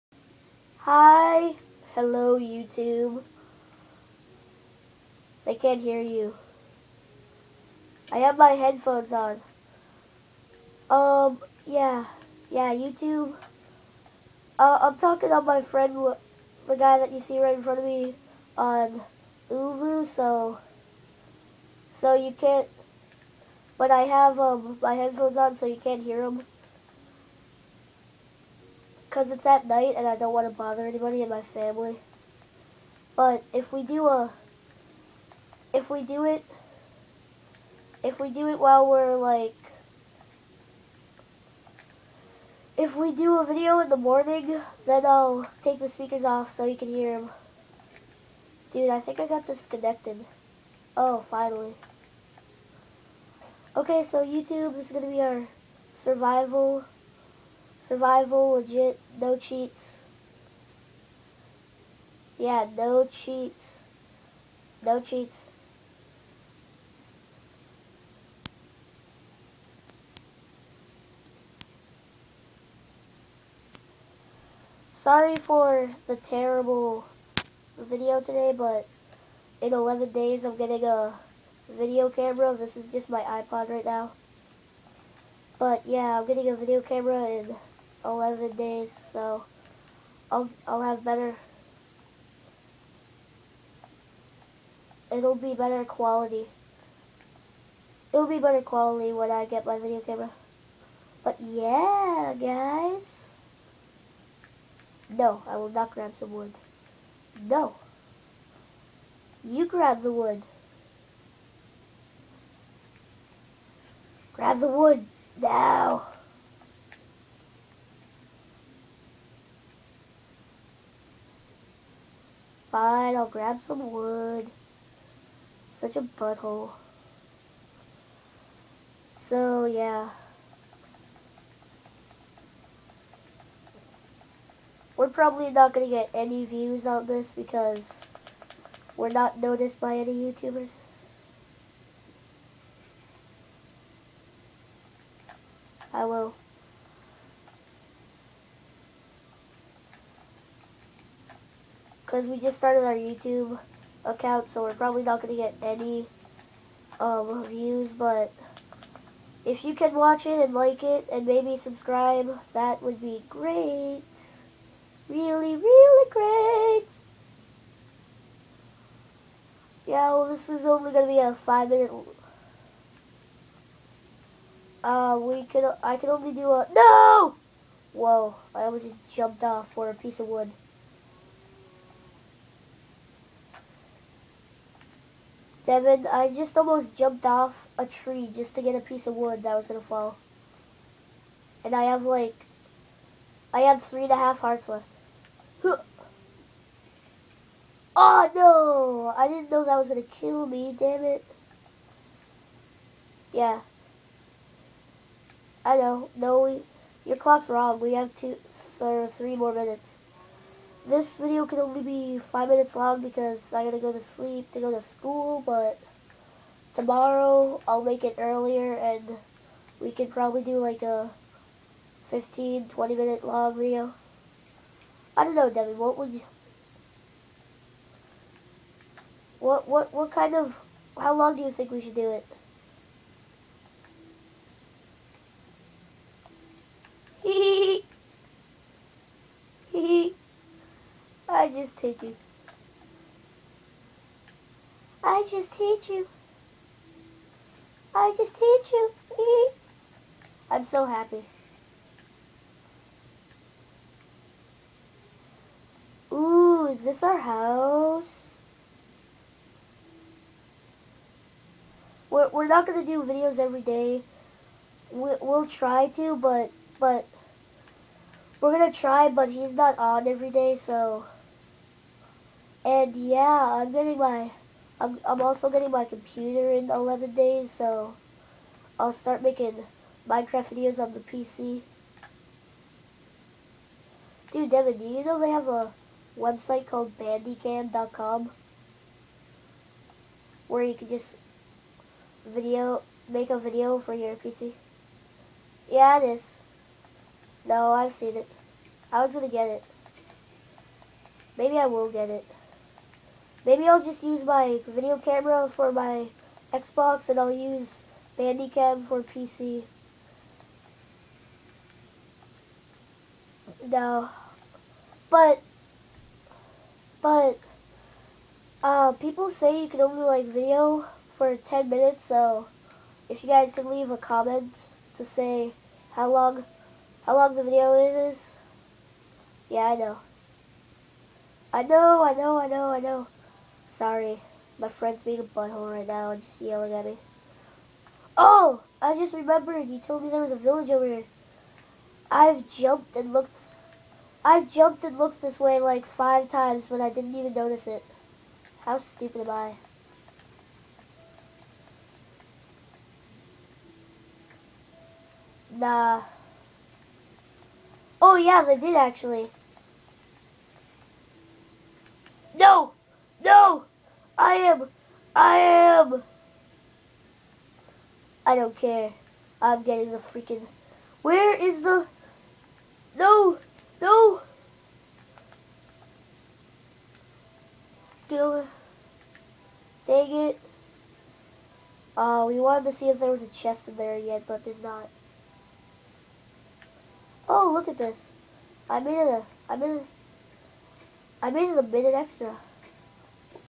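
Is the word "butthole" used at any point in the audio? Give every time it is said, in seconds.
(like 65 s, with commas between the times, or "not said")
126 s, 335 s.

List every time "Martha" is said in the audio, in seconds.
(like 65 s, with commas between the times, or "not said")
not said.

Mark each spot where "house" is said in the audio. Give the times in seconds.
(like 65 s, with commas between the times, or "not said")
257 s.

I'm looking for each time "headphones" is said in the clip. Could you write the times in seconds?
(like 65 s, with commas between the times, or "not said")
8 s, 24 s.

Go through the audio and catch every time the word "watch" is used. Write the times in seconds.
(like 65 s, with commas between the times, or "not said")
159 s.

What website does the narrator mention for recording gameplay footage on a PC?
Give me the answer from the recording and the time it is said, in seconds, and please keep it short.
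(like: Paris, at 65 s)
bandicam.com, at 286 s.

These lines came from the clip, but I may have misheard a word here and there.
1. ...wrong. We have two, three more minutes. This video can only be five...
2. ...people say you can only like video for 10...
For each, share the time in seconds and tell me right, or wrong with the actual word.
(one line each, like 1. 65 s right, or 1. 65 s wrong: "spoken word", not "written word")
1. 207 s right
2. 318 s right.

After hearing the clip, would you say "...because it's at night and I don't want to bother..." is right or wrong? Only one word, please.
right.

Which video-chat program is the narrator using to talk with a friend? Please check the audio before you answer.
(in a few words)
ooVoo.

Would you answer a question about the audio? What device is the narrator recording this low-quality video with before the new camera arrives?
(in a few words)
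iPod.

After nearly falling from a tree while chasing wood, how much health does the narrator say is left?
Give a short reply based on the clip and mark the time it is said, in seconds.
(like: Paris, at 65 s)
three and a half hearts, at 193 s.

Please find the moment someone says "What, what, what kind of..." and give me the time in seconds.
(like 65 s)
229 s.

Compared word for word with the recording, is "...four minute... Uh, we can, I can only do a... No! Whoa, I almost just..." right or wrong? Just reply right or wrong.
wrong.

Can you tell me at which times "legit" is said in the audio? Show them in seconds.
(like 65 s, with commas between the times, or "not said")
58 s.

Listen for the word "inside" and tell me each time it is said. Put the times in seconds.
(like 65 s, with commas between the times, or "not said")
not said.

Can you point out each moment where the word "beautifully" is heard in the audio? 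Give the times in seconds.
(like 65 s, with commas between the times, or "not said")
not said.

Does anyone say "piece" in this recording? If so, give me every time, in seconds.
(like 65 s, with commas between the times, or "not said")
179 s, 188 s.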